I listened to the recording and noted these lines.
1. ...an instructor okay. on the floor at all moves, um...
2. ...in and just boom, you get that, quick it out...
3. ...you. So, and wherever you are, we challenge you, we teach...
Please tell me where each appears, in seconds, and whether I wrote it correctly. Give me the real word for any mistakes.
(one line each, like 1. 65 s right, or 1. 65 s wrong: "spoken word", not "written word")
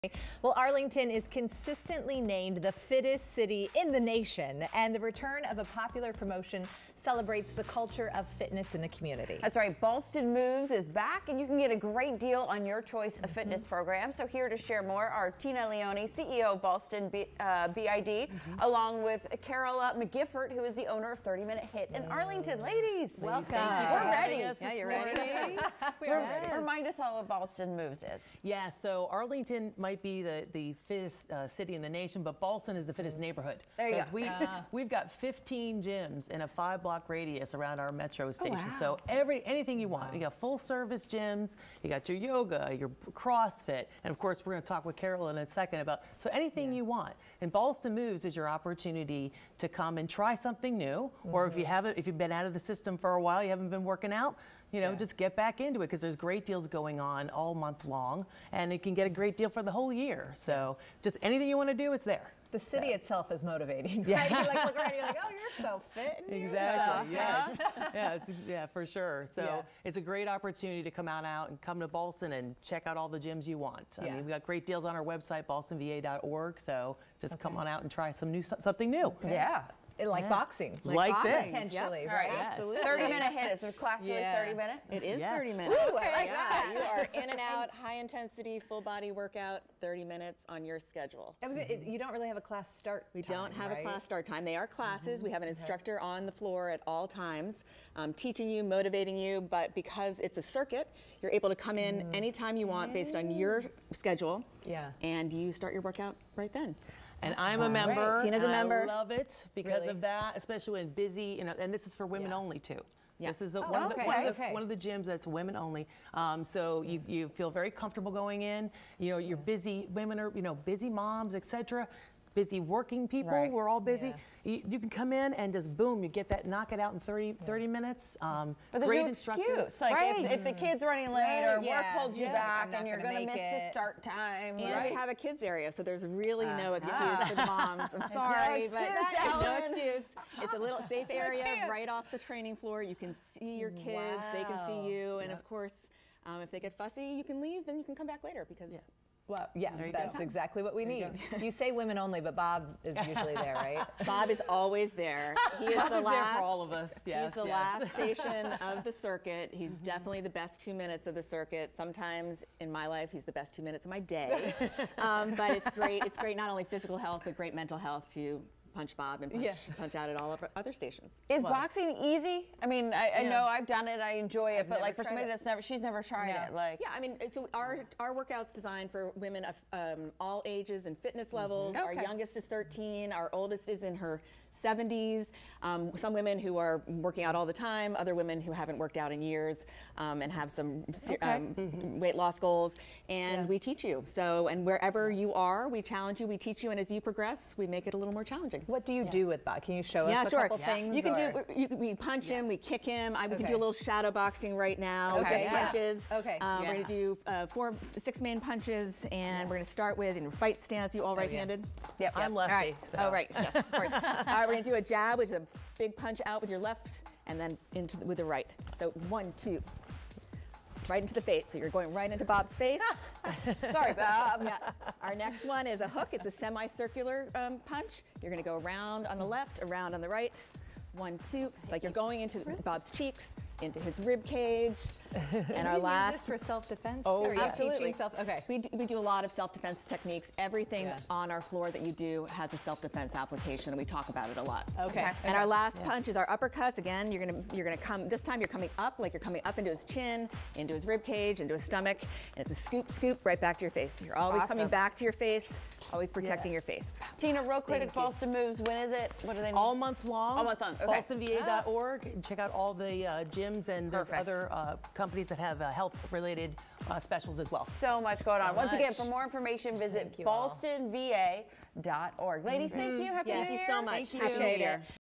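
1. 95 s wrong: "times", not "moves"
2. 125 s wrong: "knock", not "quick"
3. 193 s right.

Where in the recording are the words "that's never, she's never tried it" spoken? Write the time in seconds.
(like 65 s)
175 s.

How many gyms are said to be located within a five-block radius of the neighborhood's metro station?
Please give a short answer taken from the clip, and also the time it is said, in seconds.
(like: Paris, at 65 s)
15, at 35 s.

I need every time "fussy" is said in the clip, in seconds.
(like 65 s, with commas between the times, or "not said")
146 s.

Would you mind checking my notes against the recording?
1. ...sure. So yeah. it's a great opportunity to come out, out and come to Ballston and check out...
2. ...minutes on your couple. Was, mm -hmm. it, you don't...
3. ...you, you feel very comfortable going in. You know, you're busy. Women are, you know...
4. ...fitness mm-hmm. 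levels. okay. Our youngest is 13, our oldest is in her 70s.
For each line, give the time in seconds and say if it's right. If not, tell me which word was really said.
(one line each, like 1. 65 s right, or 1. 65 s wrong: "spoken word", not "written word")
1. 68 s right
2. 90 s wrong: "schedule", not "couple"
3. 116 s right
4. 180 s right.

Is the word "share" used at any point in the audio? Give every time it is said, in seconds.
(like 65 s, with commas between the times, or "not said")
14 s.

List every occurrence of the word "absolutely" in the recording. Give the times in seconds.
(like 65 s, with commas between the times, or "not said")
82 s, 237 s.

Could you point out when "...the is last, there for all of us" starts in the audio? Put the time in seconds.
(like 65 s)
155 s.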